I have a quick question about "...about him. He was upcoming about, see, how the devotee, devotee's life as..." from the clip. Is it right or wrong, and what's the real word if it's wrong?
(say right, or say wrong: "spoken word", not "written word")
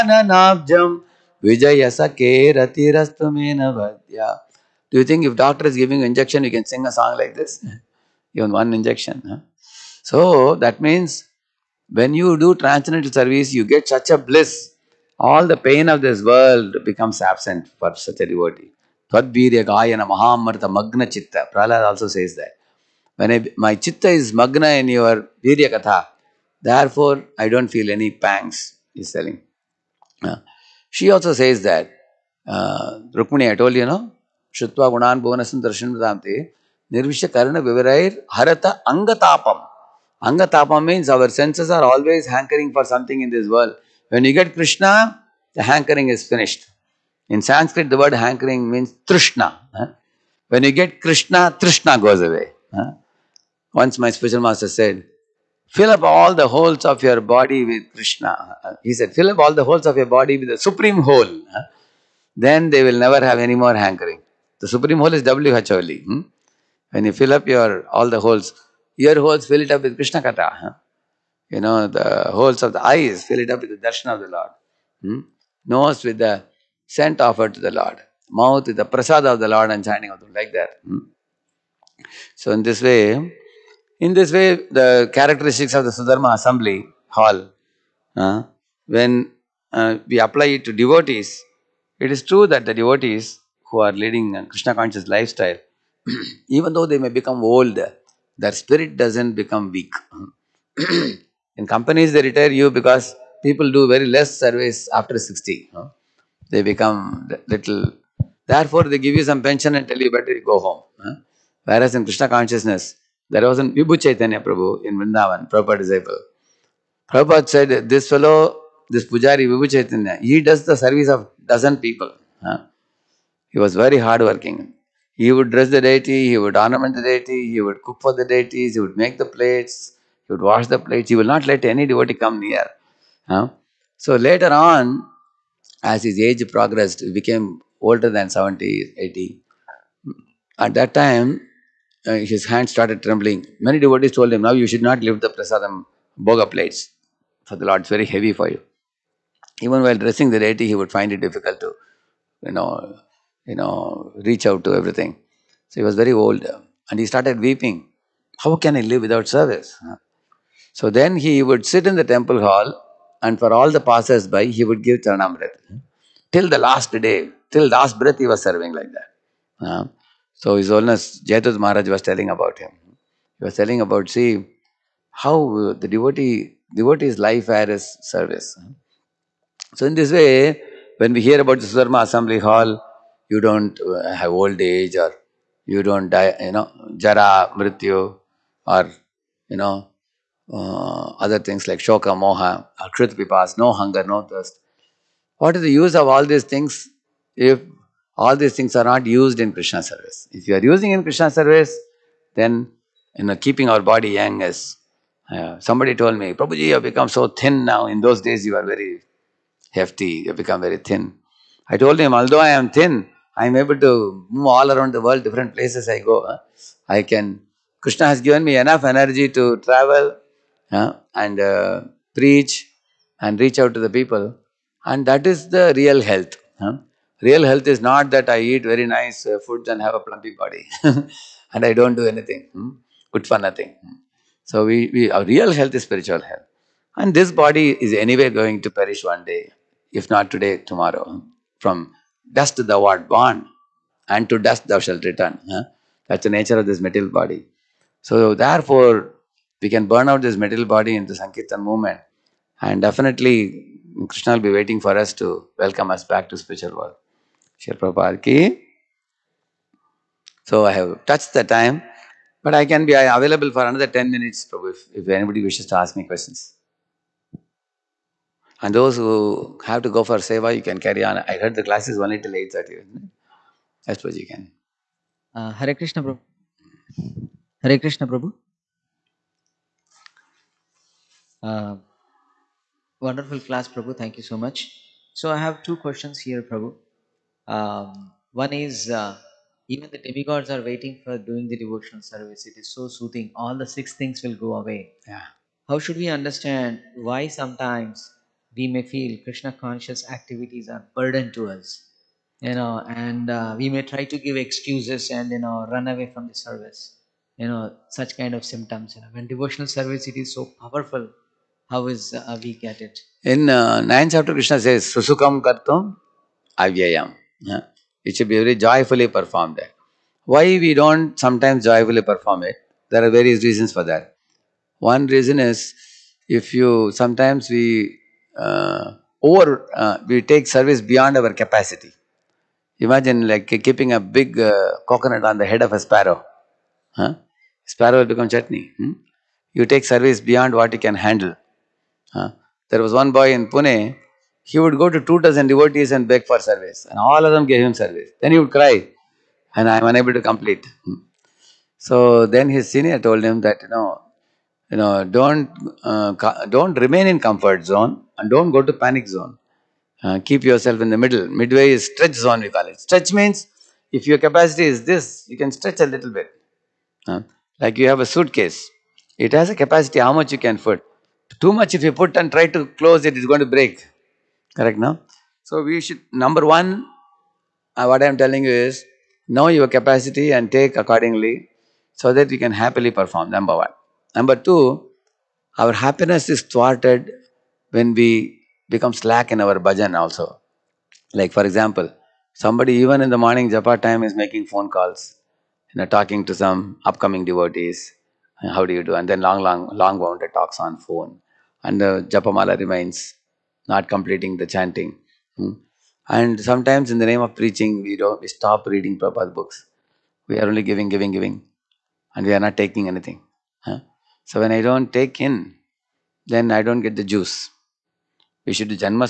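wrong: "telling", not "upcoming".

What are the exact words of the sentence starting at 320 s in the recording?
Why we don't sometimes joyfully perform it?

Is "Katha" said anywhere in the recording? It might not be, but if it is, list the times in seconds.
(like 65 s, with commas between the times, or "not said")
25 s, 70 s.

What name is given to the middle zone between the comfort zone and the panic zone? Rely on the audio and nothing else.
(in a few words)
stretch zone.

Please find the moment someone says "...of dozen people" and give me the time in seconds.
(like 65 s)
121 s.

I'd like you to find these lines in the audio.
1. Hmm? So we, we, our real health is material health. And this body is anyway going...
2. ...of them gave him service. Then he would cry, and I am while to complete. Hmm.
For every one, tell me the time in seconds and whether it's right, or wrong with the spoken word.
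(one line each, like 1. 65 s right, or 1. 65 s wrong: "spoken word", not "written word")
1. 233 s wrong: "spiritual", not "material"
2. 347 s wrong: "unable", not "while".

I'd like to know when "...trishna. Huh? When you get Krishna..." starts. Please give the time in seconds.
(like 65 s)
49 s.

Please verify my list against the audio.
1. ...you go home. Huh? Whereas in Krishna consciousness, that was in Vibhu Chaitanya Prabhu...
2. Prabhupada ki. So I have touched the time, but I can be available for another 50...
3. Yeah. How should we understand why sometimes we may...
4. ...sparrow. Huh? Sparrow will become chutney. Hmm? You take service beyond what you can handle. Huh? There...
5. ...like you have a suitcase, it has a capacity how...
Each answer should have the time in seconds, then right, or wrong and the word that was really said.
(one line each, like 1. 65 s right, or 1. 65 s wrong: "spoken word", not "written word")
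1. 110 s right
2. 257 s wrong: "10", not "50"
3. 295 s right
4. 335 s right
5. 367 s right.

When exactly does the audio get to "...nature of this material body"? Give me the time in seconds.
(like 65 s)
246 s.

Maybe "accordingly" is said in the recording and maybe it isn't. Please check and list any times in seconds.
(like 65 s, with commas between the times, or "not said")
380 s.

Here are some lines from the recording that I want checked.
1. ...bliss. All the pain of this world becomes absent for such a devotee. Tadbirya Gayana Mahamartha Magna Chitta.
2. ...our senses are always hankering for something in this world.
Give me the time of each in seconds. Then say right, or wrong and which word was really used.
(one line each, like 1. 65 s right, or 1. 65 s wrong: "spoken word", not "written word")
1. 14 s right
2. 41 s right.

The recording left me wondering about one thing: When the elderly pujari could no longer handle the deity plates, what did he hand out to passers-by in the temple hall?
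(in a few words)
Charanamrita.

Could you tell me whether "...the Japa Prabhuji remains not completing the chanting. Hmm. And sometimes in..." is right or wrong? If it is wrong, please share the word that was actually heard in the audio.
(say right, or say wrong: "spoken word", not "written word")
wrong: "Mala", not "Prabhuji".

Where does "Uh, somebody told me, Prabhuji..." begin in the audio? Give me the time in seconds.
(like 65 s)
205 s.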